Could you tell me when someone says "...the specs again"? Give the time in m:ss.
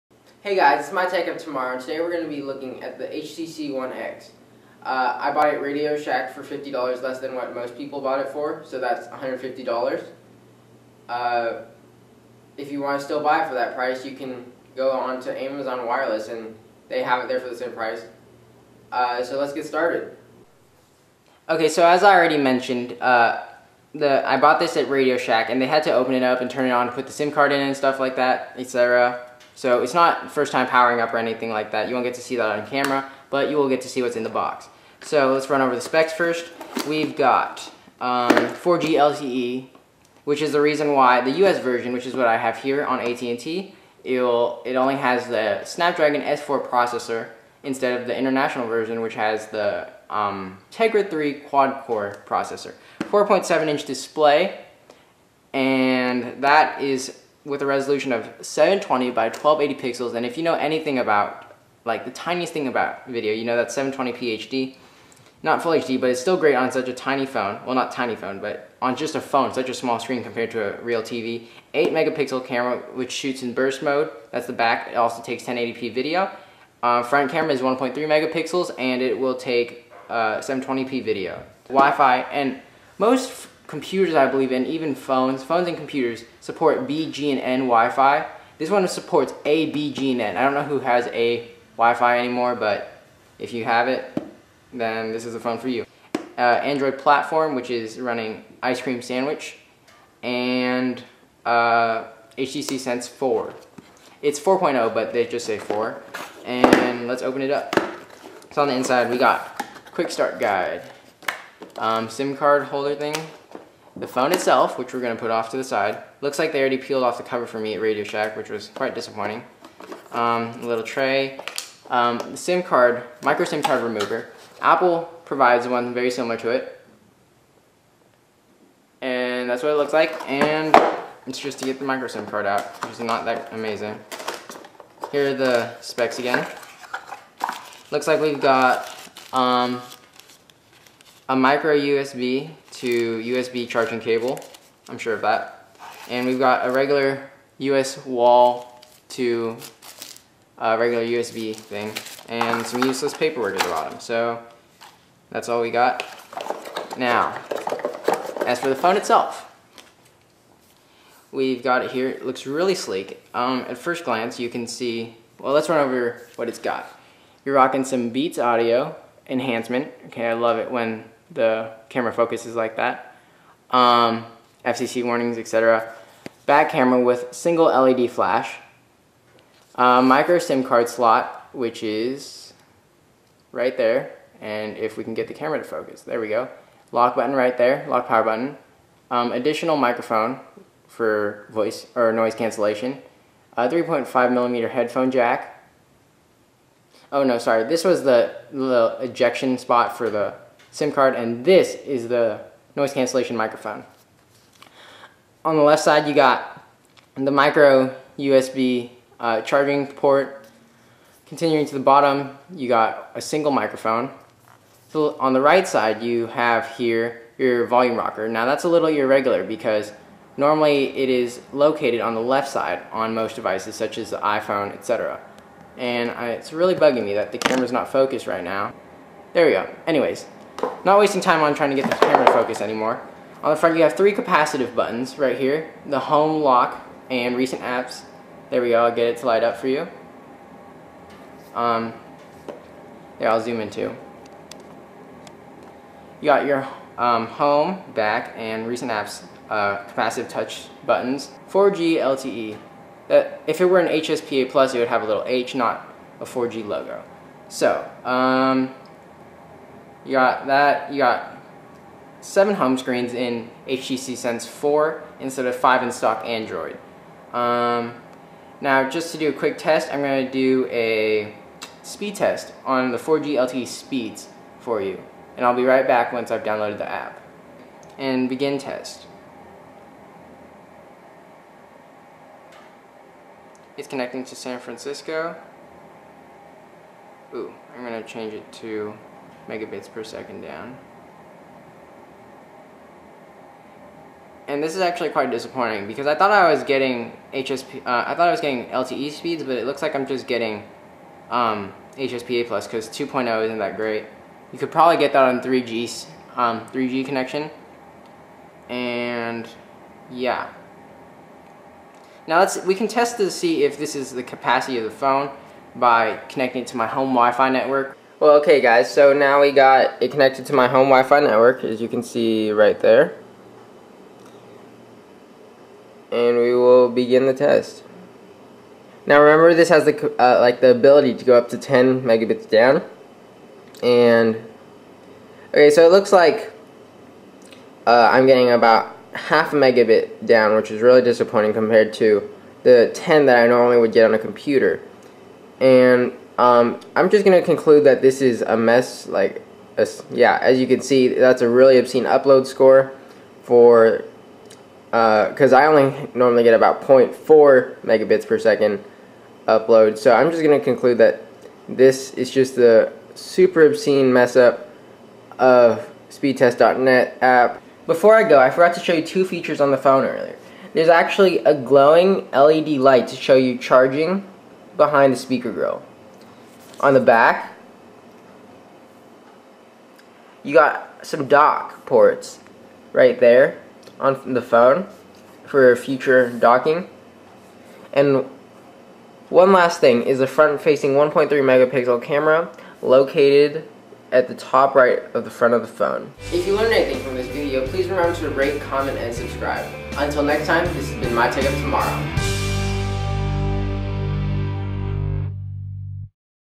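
2:15.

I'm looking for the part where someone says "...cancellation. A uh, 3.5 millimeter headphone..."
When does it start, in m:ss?
3:12.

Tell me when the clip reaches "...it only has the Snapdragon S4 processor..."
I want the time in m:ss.
0:44.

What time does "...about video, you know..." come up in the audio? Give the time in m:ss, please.
1:02.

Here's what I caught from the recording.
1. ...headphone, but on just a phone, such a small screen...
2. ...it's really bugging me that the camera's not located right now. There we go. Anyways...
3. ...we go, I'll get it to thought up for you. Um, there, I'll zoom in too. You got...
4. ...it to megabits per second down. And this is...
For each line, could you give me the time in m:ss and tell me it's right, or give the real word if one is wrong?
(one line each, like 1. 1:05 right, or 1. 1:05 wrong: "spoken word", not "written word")
1. 1:08 wrong: "phone", not "headphone"
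2. 3:46 wrong: "focused", not "located"
3. 3:58 wrong: "light", not "thought"
4. 4:48 right.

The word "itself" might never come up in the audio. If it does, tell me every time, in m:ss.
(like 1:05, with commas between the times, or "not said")
1:54, 2:38.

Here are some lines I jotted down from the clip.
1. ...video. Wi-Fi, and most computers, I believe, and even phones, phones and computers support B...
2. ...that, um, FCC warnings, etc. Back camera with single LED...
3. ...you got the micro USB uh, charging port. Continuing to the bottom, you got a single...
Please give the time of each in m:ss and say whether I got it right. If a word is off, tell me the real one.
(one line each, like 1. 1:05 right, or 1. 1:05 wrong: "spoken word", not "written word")
1. 1:21 right
2. 2:52 right
3. 3:26 right.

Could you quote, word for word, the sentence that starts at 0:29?
So it's not first time powering up or anything like that.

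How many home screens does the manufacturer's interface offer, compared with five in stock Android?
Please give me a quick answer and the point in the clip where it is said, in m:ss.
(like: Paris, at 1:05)
7, at 4:22.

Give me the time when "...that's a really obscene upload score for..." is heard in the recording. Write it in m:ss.
5:51.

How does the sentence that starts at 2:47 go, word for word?
You're rocking some Beats Audio enhancement.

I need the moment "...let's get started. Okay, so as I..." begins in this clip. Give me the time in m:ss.
0:19.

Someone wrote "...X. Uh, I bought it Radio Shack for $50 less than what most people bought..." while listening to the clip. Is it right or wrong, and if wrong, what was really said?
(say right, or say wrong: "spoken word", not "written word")
right.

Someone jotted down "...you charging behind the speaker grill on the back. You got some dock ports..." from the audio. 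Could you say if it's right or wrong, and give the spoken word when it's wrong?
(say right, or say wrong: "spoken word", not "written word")
right.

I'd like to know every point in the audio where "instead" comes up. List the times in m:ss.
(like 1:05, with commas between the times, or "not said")
0:47, 4:25.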